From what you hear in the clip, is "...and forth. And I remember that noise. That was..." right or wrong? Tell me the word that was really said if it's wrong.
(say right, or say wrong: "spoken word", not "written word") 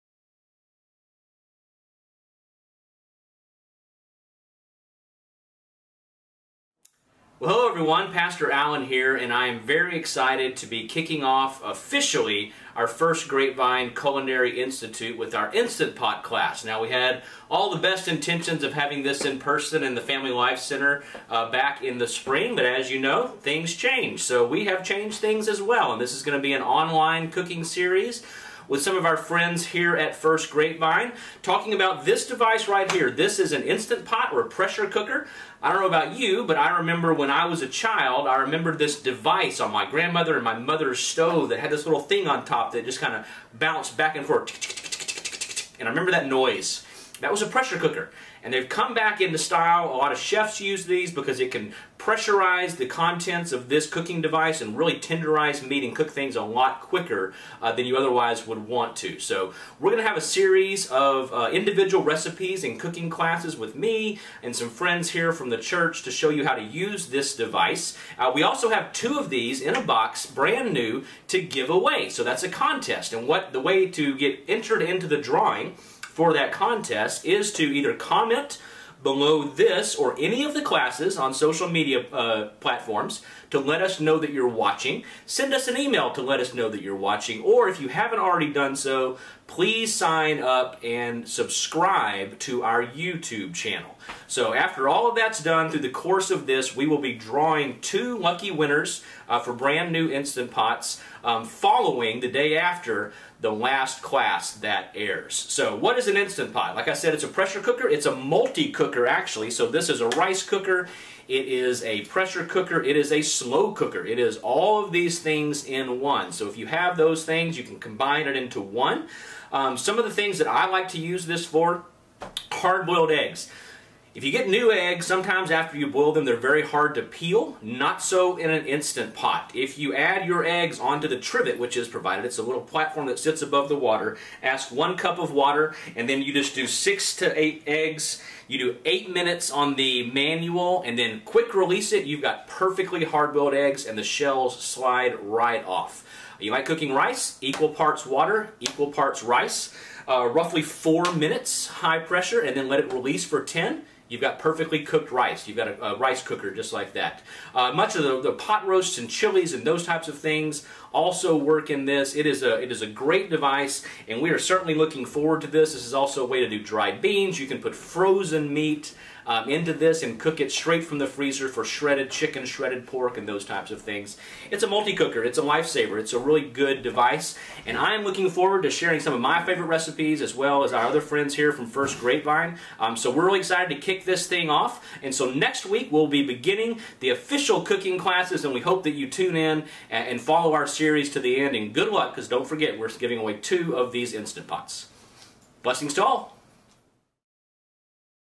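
right.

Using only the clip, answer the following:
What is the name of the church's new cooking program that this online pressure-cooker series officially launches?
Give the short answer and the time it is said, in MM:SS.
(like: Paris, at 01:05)
Grapevine Culinary Institute, at 00:13.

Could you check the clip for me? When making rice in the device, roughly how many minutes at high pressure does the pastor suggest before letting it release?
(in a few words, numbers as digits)
4.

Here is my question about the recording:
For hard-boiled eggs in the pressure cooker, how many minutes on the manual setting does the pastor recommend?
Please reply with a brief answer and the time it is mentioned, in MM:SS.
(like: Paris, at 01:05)
8, at 02:18.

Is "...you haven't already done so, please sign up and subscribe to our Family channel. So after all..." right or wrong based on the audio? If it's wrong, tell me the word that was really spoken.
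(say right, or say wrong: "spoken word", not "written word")
wrong: "YouTube", not "Family".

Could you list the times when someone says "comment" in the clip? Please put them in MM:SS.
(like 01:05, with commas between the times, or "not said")
01:17.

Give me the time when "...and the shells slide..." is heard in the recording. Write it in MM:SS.
02:23.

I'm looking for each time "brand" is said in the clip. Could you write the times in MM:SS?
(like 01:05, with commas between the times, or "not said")
01:10, 01:39.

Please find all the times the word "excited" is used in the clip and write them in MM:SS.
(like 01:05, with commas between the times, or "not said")
00:09, 03:03.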